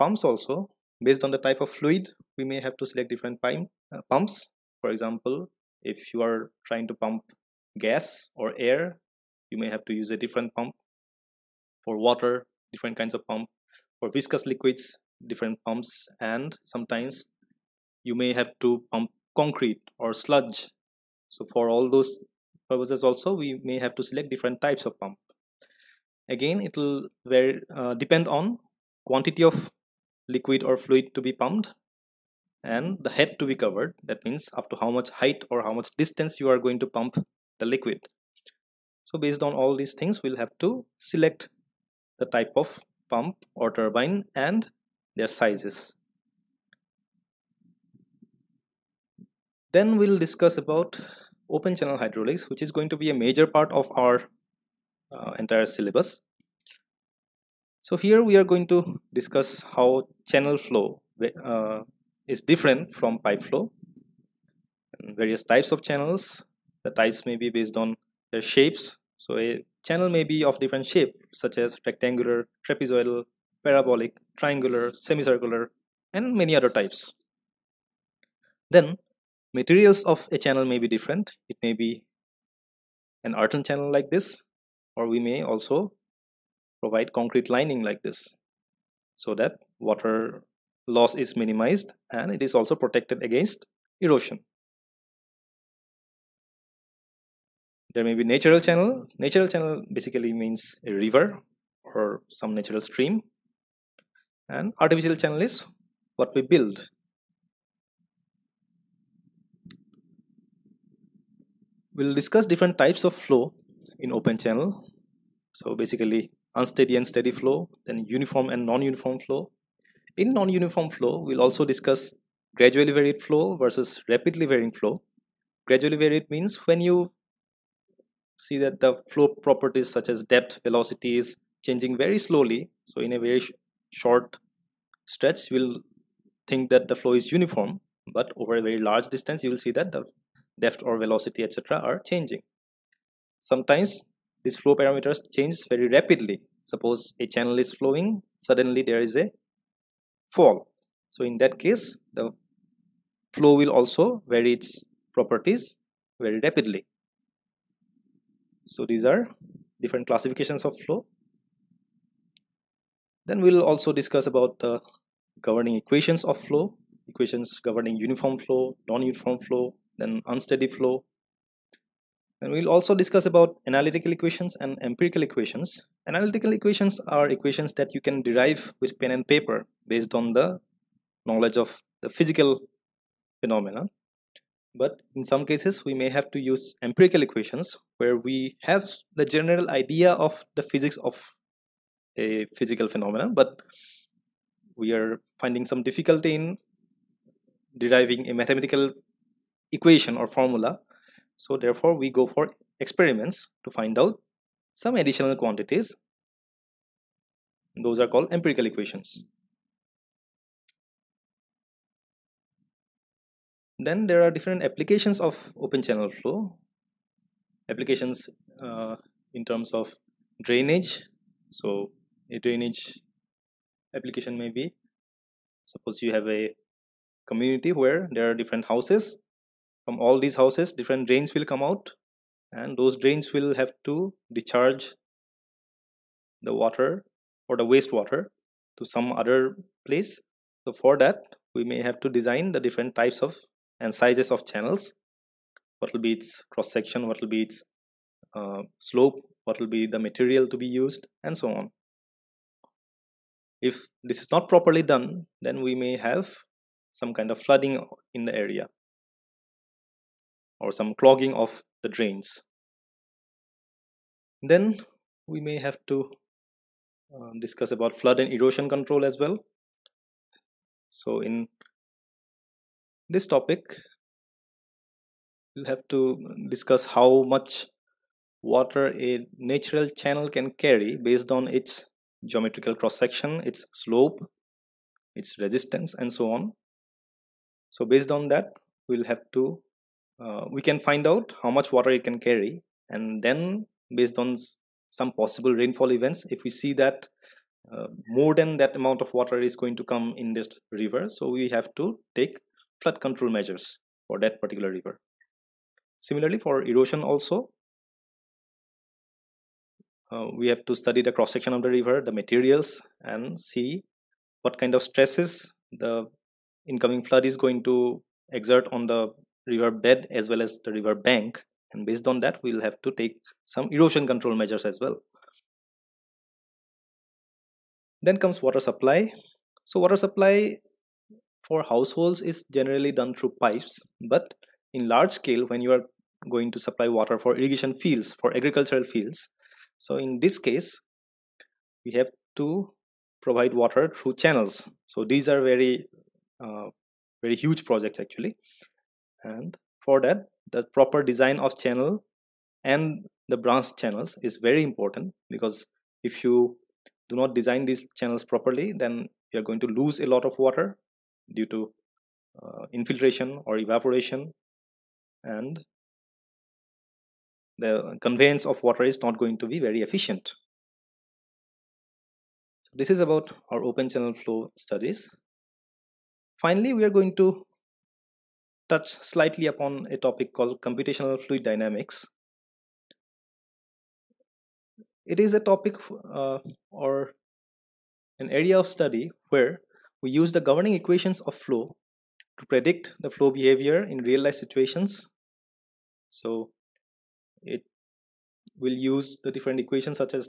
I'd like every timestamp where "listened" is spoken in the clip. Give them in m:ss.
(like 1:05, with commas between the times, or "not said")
not said.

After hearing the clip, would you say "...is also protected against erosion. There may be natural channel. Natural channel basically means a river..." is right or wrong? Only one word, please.
right.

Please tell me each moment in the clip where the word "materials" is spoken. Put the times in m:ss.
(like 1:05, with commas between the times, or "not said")
1:19, 4:09, 5:12.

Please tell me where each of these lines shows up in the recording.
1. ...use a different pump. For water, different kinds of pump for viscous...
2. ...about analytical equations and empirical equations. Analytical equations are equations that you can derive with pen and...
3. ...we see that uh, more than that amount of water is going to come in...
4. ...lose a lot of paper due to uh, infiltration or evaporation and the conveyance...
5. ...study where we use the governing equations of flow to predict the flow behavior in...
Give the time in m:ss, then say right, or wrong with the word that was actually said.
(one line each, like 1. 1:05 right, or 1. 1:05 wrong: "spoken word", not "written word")
1. 0:09 right
2. 2:53 right
3. 4:56 right
4. 5:59 wrong: "water", not "paper"
5. 6:28 right.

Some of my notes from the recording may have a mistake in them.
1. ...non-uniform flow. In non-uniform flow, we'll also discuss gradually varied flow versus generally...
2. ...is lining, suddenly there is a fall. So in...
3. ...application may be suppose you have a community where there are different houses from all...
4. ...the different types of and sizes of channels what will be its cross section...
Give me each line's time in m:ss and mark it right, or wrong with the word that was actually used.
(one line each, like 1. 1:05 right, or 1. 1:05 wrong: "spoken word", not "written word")
1. 1:58 wrong: "rapidly", not "generally"
2. 2:27 wrong: "flowing", not "lining"
3. 3:43 right
4. 4:02 right.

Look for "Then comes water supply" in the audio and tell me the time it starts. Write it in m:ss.
5:28.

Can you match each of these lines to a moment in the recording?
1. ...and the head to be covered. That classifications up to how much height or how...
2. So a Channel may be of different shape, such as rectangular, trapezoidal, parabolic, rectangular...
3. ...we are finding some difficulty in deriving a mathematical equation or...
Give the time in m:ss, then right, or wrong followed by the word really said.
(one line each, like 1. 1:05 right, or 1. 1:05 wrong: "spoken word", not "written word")
1. 0:32 wrong: "means", not "classifications"
2. 1:09 wrong: "triangular", not "rectangular"
3. 3:14 right.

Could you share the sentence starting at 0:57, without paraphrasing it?
So here we are going to discuss how channel flow uh, is different from pipe flow various types of channels.